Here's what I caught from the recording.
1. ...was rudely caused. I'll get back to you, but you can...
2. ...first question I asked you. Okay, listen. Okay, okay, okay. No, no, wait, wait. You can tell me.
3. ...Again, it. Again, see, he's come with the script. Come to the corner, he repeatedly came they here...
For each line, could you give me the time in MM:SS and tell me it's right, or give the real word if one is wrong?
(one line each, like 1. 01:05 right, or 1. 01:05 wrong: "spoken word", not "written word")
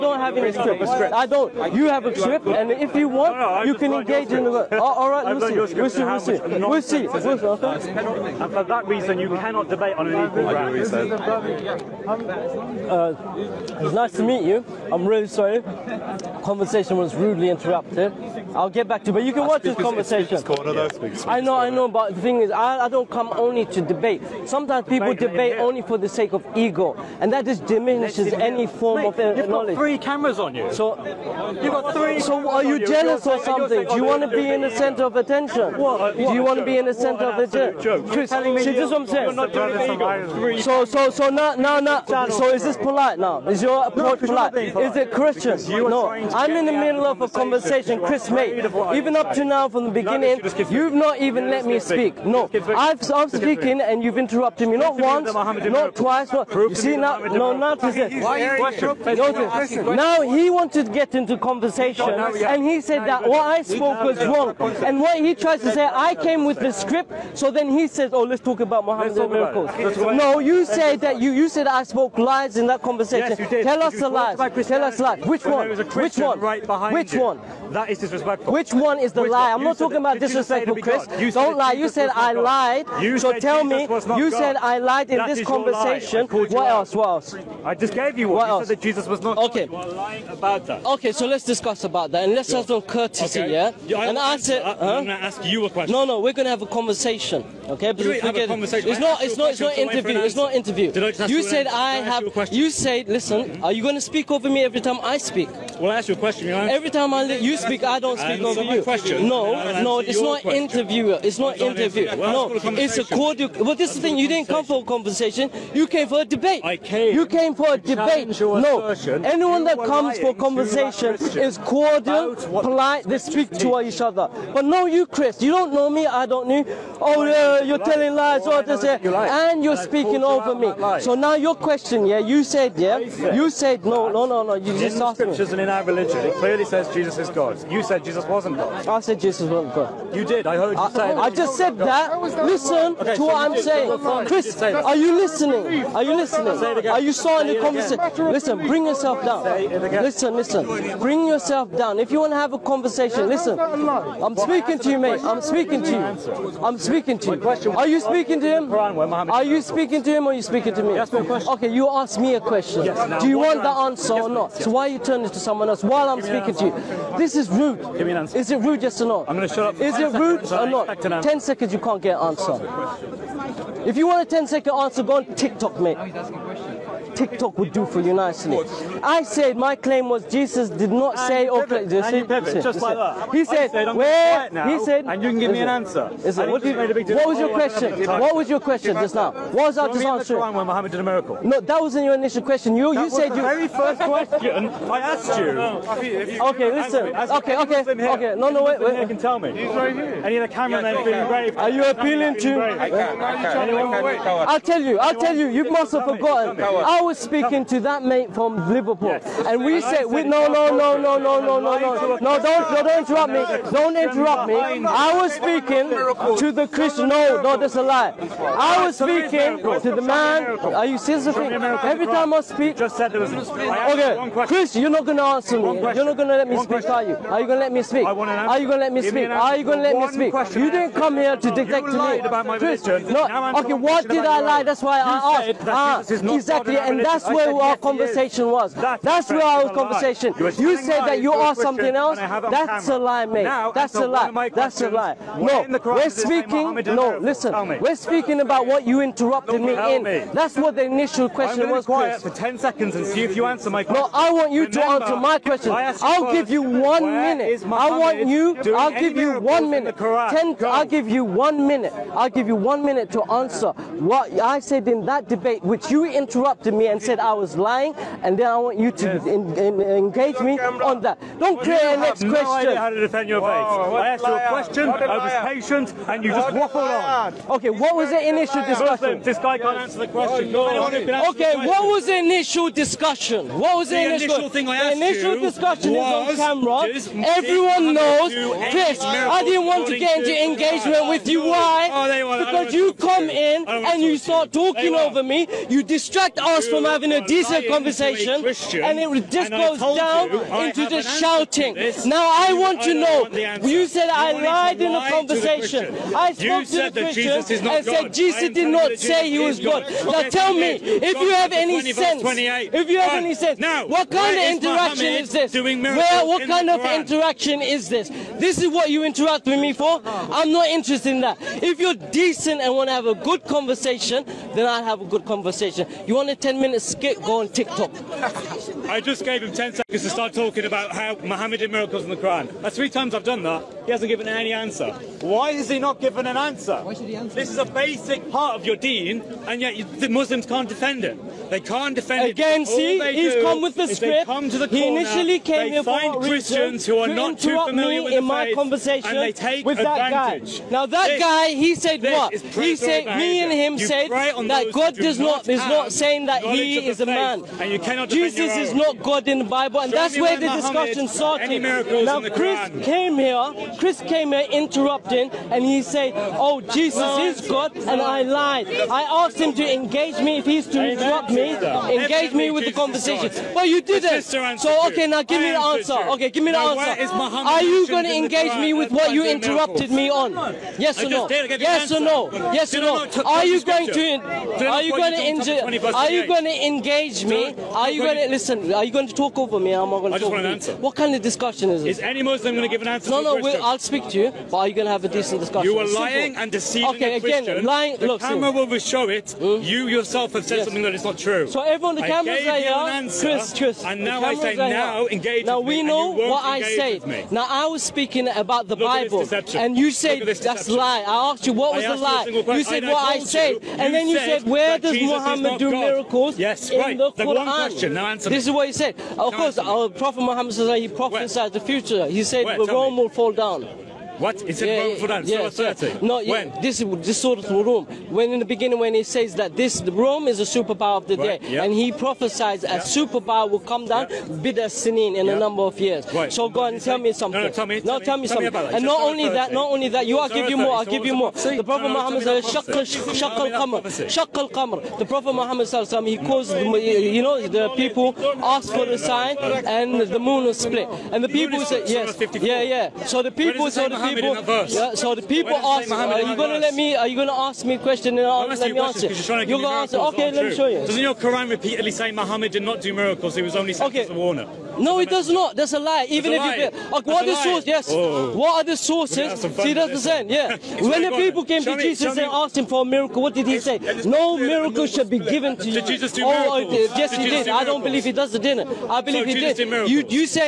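1. 00:16 wrong: "interrupted", not "caused"
2. 03:13 right
3. 05:42 wrong: "initially", not "repeatedly".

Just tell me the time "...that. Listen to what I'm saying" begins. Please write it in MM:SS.
02:21.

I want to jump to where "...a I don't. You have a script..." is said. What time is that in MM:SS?
00:00.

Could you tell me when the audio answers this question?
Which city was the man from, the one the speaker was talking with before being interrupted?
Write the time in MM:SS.
03:28.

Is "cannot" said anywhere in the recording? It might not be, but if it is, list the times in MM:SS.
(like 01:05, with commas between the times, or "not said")
00:09, 05:57.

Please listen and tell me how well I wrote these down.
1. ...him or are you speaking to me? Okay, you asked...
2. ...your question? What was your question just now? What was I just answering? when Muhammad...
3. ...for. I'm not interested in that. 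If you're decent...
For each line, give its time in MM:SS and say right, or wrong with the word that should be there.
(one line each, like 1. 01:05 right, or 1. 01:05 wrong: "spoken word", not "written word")
1. 02:40 right
2. 03:07 right
3. 05:19 right.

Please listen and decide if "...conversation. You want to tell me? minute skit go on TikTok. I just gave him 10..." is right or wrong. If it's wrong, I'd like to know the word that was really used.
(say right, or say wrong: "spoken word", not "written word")
right.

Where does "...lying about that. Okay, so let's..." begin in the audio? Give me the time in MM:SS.
01:30.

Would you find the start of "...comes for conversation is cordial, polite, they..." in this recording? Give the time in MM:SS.
01:59.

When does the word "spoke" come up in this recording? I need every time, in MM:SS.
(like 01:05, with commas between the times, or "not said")
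01:03, 01:11, 05:06.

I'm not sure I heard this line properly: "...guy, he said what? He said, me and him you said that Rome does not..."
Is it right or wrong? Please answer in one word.
wrong.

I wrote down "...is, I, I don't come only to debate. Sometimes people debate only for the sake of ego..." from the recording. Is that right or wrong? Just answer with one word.
right.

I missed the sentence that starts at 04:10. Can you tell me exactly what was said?
That's what the initial question was.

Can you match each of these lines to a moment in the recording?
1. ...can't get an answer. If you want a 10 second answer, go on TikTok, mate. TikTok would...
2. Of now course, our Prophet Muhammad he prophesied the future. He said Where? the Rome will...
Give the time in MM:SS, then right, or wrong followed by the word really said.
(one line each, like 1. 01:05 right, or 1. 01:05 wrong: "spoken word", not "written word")
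1. 02:51 right
2. 06:59 right.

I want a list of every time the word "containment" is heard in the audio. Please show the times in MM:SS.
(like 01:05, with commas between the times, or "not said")
not said.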